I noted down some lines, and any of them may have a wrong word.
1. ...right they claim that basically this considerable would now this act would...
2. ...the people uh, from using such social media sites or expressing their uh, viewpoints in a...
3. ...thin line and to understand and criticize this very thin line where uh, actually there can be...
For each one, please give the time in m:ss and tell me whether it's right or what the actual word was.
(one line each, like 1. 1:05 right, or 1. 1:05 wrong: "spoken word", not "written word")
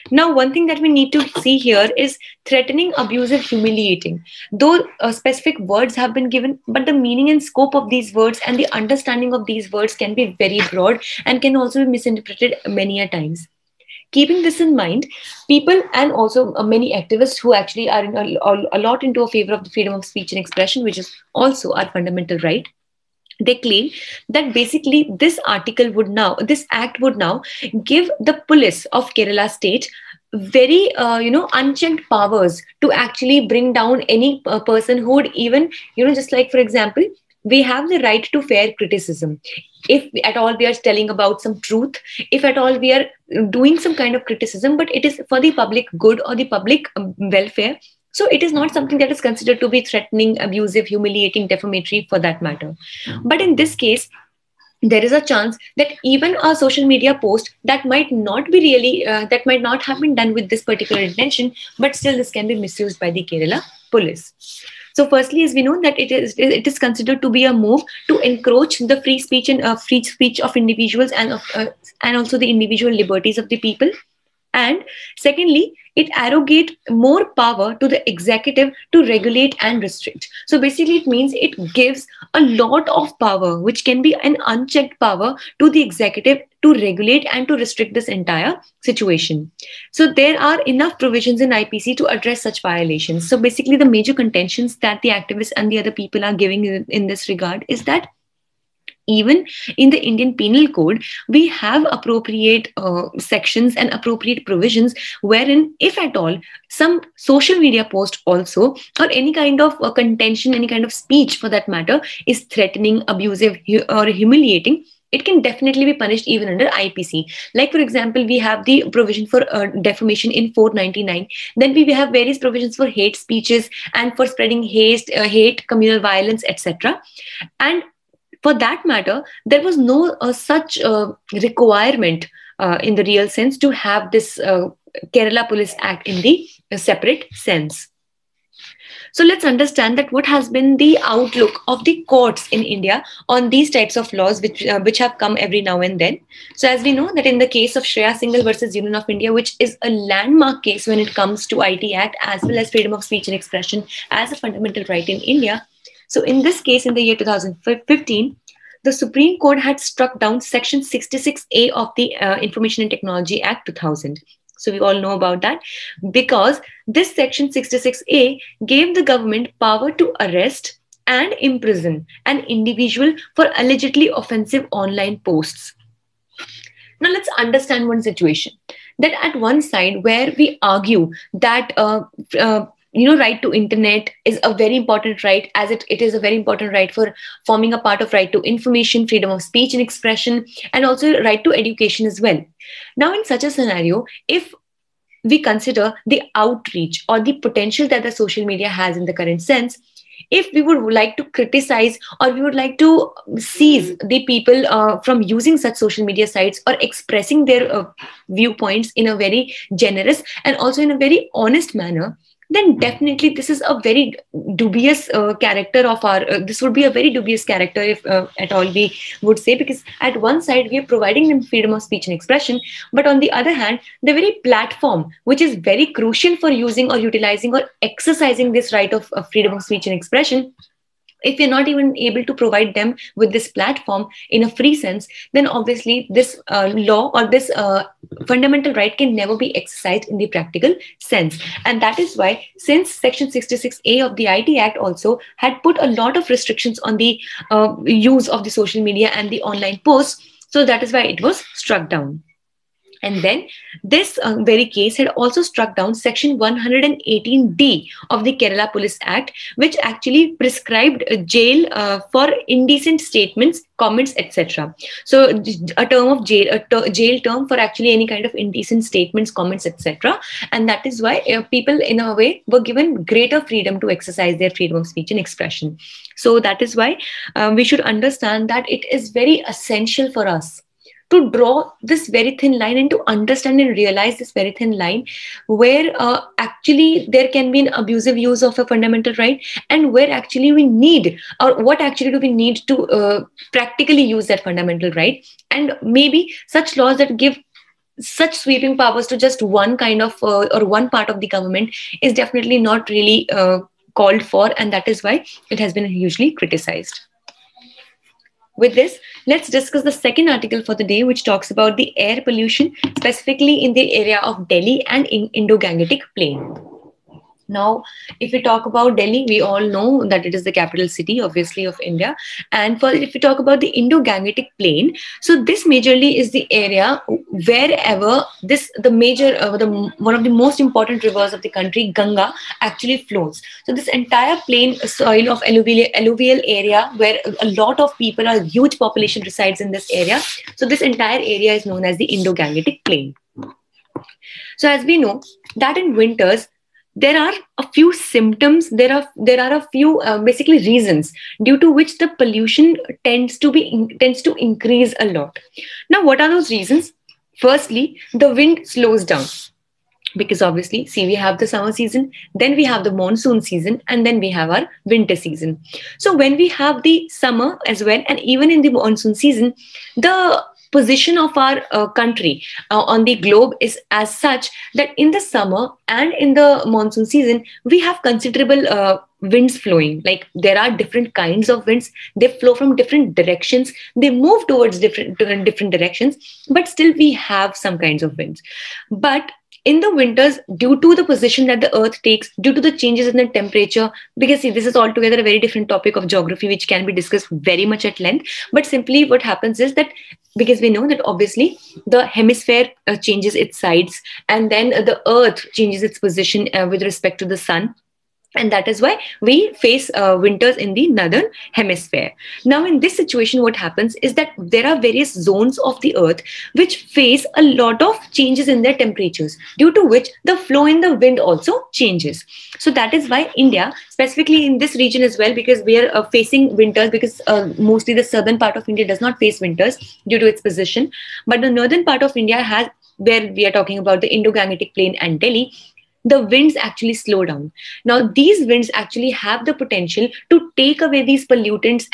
1. 0:22 wrong: "article", not "considerable"
2. 3:23 right
3. 4:42 wrong: "realize", not "criticize".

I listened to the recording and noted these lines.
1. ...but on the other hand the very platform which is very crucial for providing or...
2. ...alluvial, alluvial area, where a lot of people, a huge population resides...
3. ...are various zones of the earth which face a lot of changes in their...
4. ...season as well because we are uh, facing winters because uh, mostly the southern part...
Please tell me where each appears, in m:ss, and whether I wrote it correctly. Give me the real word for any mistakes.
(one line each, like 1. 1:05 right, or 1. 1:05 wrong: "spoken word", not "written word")
1. 3:42 wrong: "using", not "providing"
2. 5:35 right
3. 6:54 right
4. 7:04 wrong: "region", not "season".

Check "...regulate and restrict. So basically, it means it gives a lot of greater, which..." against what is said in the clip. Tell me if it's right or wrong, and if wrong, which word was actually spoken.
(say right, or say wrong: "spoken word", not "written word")
wrong: "power", not "greater".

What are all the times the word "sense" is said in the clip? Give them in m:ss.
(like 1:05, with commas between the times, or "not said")
2:13, 2:17, 3:19, 3:54, 4:01.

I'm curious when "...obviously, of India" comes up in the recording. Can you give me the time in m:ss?
5:21.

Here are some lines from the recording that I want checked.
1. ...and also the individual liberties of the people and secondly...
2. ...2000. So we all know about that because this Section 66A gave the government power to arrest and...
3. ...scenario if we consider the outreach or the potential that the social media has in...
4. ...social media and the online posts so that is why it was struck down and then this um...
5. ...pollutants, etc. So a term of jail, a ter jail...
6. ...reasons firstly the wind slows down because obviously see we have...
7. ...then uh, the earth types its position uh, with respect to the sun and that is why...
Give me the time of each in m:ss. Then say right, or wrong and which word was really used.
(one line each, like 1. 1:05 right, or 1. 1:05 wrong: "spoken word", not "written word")
1. 1:12 right
2. 2:43 right
3. 3:13 right
4. 4:08 right
5. 4:23 wrong: "comments", not "pollutants"
6. 5:56 right
7. 6:44 wrong: "changes", not "types".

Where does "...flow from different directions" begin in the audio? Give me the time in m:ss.
6:22.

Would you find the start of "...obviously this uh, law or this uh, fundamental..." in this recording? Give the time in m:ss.
3:55.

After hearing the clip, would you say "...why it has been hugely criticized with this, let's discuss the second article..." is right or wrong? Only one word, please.
right.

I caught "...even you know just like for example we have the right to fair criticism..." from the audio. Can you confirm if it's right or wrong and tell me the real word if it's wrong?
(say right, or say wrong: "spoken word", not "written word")
right.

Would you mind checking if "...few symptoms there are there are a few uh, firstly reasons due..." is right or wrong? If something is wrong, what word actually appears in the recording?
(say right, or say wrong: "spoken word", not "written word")
wrong: "basically", not "firstly".